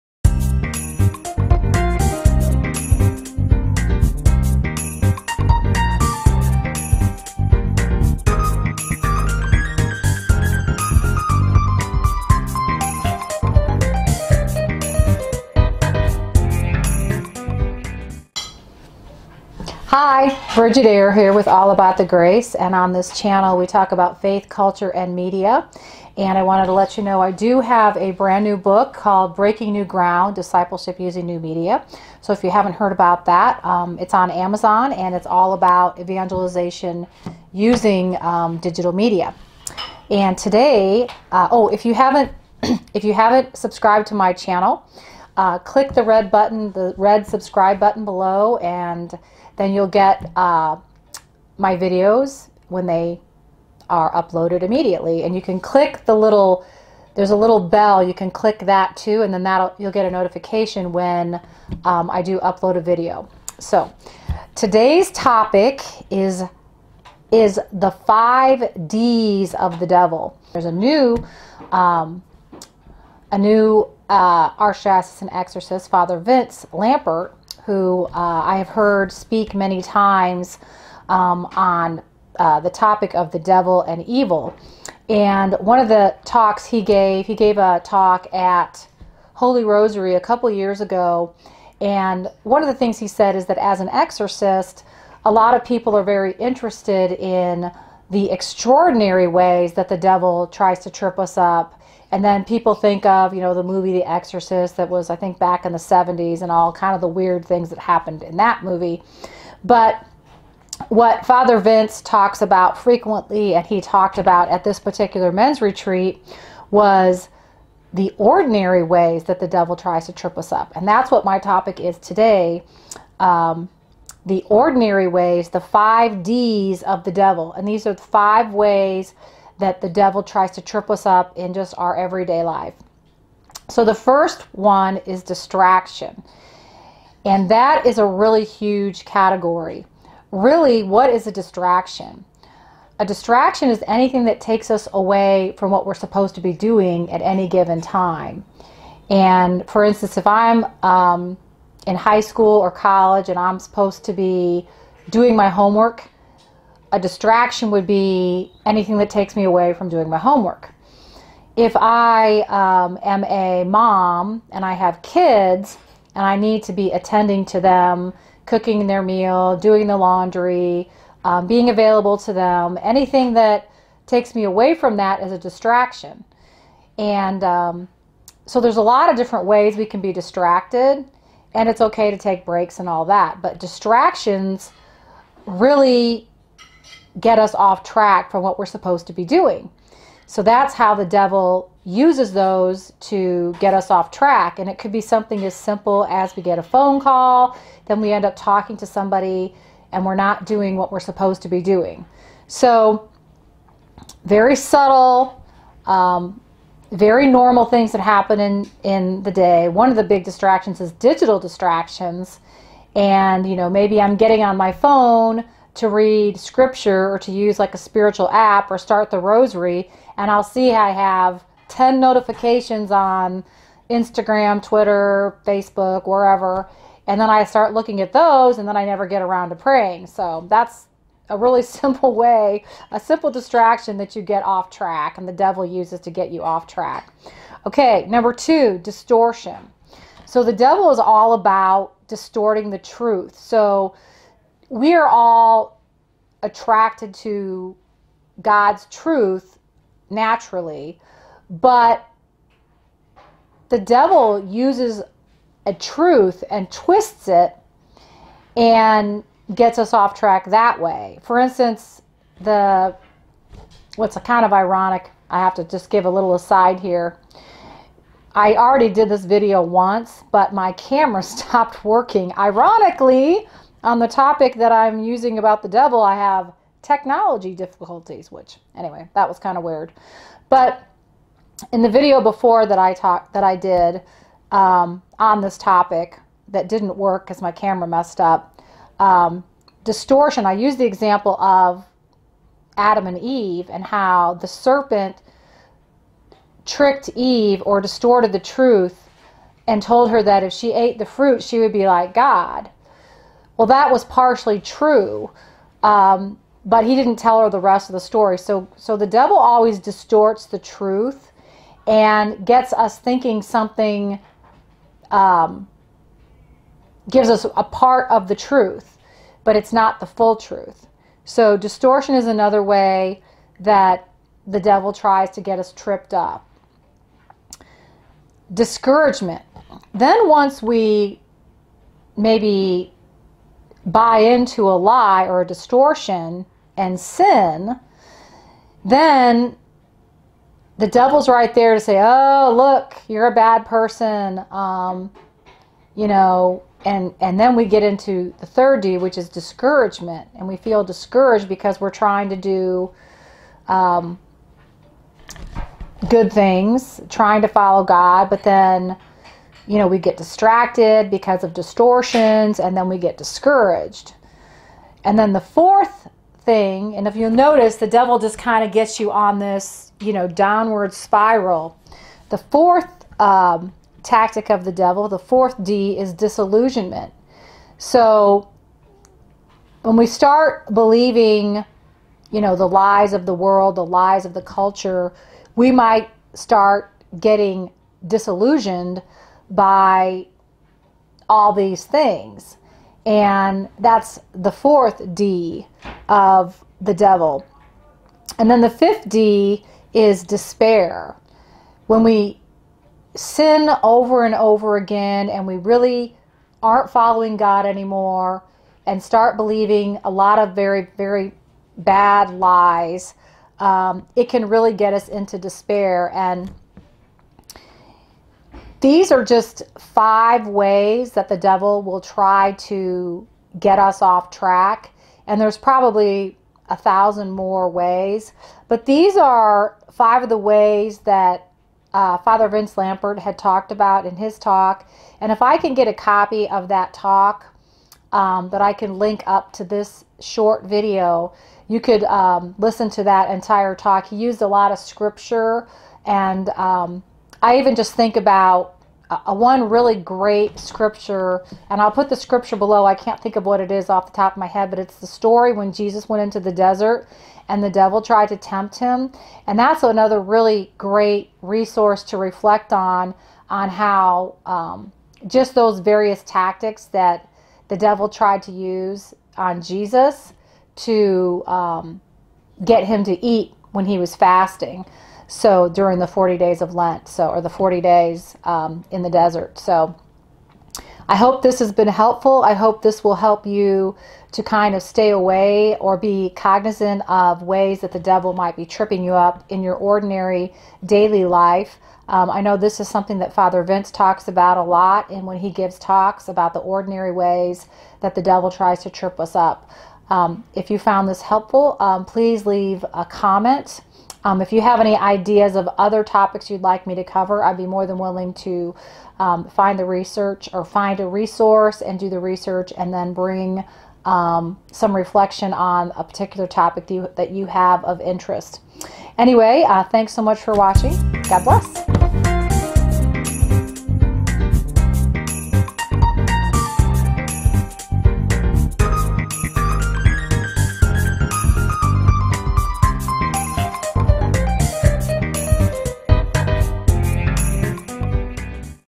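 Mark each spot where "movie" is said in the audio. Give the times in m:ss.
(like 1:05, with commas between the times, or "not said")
1:43, 1:48.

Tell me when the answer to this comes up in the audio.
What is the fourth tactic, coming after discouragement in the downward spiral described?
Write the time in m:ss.
6:16.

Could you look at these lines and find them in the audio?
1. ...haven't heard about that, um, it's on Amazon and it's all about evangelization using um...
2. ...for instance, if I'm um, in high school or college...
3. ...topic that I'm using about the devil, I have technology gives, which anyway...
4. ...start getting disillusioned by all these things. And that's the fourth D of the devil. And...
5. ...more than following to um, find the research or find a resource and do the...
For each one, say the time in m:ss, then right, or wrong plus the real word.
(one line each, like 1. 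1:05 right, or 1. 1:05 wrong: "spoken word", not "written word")
1. 0:32 right
2. 2:29 right
3. 4:34 wrong: "difficulties", not "gives"
4. 6:26 right
5. 8:27 wrong: "willing", not "following".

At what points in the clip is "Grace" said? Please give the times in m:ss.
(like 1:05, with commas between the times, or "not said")
0:22.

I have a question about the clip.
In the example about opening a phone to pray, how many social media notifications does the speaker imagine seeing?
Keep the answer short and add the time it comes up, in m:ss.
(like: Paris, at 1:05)
10, at 3:41.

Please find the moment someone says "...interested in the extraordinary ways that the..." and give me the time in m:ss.
1:36.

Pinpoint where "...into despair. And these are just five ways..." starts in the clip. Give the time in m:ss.
6:55.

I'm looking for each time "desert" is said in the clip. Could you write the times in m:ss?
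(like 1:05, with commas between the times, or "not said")
7:36, 7:59.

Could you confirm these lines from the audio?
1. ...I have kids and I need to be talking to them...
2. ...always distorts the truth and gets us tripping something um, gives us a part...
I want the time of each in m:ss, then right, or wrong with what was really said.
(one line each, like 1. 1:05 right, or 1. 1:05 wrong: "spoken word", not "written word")
1. 2:44 wrong: "attending", not "talking"
2. 5:09 wrong: "thinking", not "tripping".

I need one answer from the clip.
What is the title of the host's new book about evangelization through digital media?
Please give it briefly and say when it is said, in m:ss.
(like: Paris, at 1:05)
Breaking New Ground, at 0:29.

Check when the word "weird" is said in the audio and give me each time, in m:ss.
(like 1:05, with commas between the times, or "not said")
1:47, 4:39.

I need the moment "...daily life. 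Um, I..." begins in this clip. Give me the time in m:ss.
8:10.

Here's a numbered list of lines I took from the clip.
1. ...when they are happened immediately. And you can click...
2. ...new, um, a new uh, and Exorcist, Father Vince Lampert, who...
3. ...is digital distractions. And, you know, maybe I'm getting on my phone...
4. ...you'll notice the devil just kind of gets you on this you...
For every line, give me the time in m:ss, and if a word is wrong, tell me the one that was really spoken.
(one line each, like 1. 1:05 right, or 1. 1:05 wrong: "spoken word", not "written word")
1. 0:52 wrong: "uploaded", not "happened"
2. 1:10 right
3. 3:30 right
4. 6:07 right.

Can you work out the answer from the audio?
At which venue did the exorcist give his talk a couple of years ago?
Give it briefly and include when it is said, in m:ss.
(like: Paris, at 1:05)
Holy Rosary, at 1:29.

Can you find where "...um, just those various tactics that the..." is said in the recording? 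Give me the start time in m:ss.
7:44.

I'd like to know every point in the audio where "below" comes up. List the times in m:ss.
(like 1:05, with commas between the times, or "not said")
0:48, 7:32.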